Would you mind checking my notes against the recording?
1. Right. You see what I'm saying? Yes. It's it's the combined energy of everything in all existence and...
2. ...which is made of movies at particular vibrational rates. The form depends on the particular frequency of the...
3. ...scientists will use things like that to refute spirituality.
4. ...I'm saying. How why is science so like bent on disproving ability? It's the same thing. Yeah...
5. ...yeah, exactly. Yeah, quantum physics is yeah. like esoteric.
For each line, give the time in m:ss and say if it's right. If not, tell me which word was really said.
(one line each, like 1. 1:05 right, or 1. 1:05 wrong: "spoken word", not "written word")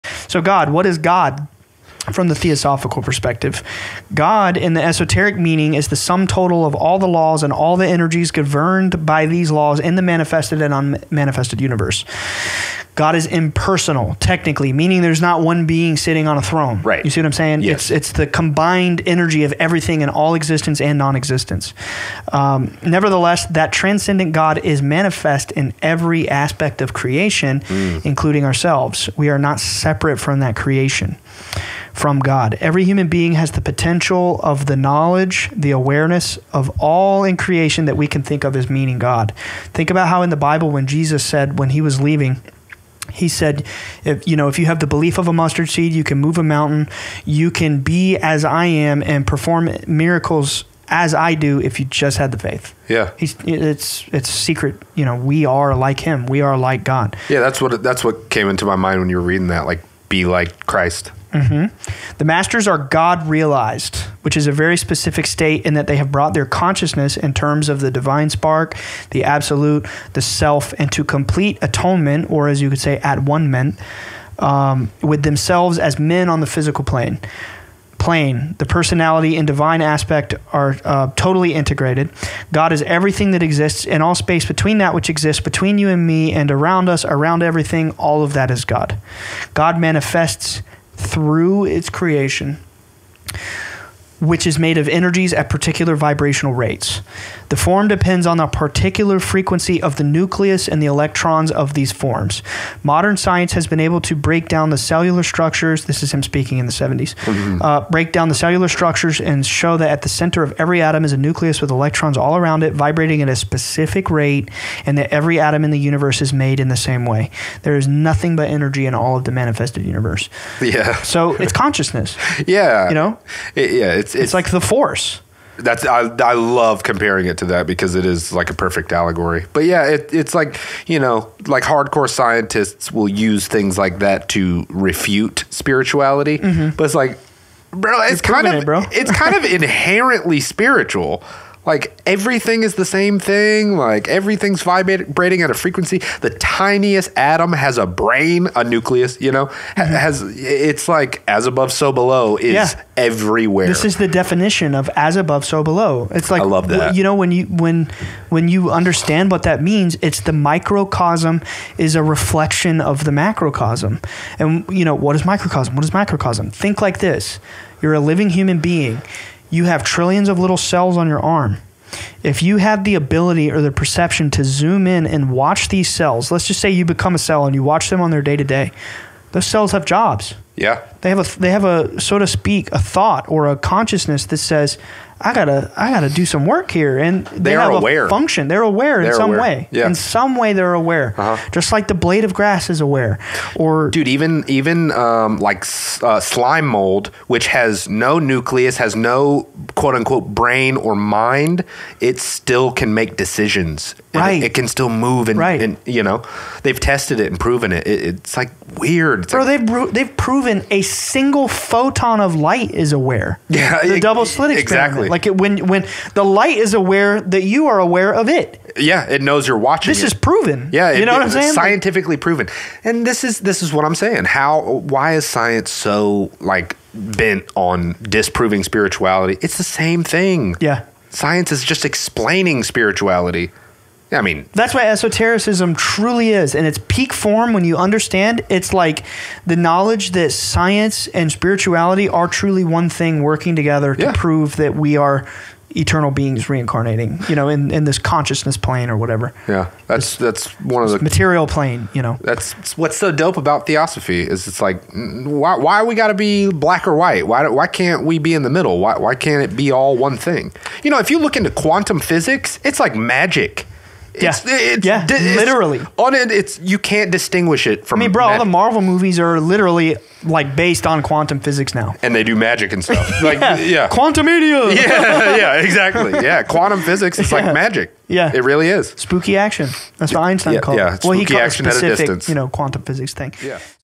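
1. 0:16 right
2. 1:34 wrong: "energies", not "movies"
3. 2:12 right
4. 3:43 wrong: "spirituality", not "ability"
5. 4:35 wrong: "magic", not "esoteric".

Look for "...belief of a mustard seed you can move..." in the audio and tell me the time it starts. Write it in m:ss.
0:44.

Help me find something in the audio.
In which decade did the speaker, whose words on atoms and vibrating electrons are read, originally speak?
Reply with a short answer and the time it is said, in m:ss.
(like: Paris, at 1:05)
the 70s, at 1:46.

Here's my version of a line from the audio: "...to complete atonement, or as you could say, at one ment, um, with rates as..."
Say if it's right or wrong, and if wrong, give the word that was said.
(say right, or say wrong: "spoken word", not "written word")
wrong: "themselves", not "rates".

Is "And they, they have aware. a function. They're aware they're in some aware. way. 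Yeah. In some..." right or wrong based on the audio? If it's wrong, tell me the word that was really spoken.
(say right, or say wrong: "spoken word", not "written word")
right.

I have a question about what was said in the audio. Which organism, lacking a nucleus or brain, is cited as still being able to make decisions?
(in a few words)
slime mold.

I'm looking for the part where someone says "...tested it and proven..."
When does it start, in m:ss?
3:26.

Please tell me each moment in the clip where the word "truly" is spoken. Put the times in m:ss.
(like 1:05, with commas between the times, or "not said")
3:55, 4:02.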